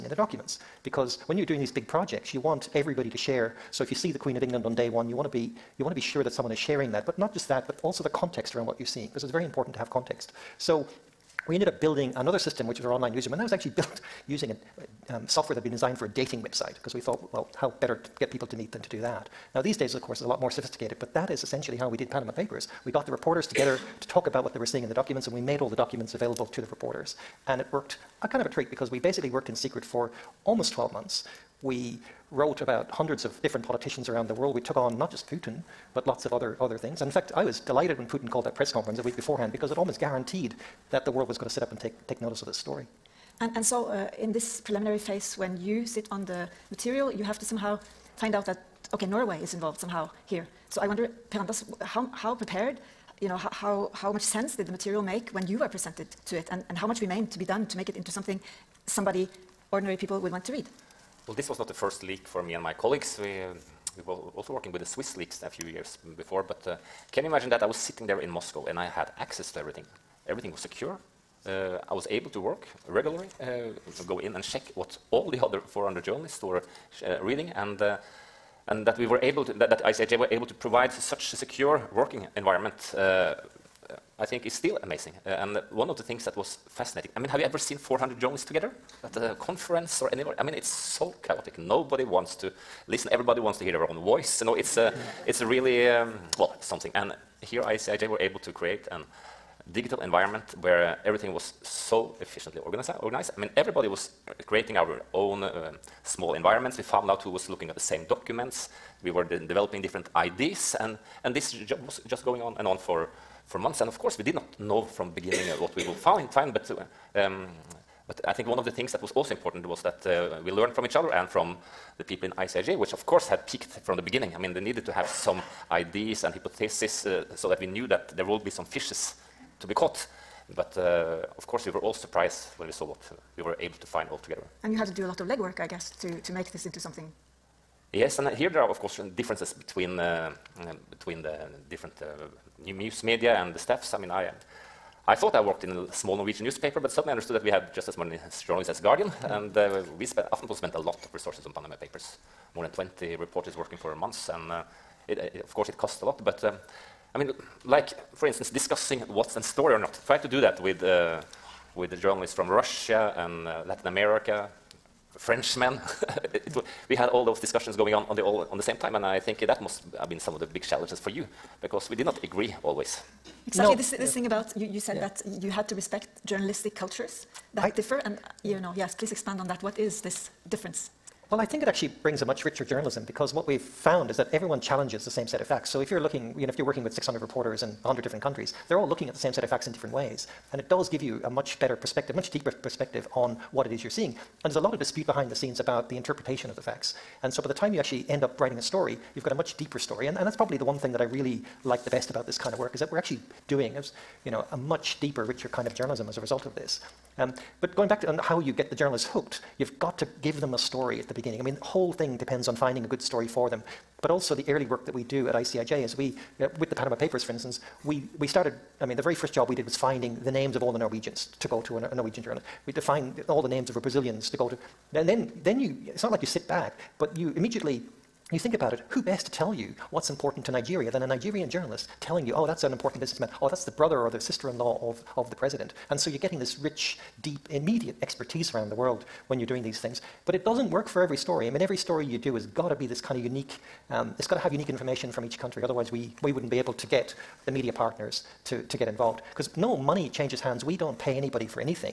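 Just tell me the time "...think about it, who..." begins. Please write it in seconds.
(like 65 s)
228 s.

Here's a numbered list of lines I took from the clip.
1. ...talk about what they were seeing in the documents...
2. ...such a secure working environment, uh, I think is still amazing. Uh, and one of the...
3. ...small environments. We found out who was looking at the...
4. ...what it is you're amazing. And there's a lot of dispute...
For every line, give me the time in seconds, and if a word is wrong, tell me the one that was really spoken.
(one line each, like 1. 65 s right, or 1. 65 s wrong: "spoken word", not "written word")
1. 24 s right
2. 80 s right
3. 106 s right
4. 193 s wrong: "seeing", not "amazing".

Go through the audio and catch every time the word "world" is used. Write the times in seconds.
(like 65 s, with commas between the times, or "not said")
34 s, 41 s, 238 s.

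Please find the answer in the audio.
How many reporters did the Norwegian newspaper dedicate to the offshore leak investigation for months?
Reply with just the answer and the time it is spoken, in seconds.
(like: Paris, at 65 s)
More than 20, at 152 s.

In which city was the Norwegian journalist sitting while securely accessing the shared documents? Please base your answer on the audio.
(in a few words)
Moscow.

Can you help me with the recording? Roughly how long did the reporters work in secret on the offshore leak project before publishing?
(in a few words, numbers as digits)
Almost 12 months.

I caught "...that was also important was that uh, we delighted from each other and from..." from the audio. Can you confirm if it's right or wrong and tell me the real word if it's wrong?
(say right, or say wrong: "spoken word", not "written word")
wrong: "learned", not "delighted".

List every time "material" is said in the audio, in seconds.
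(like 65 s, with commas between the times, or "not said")
46 s, 54 s.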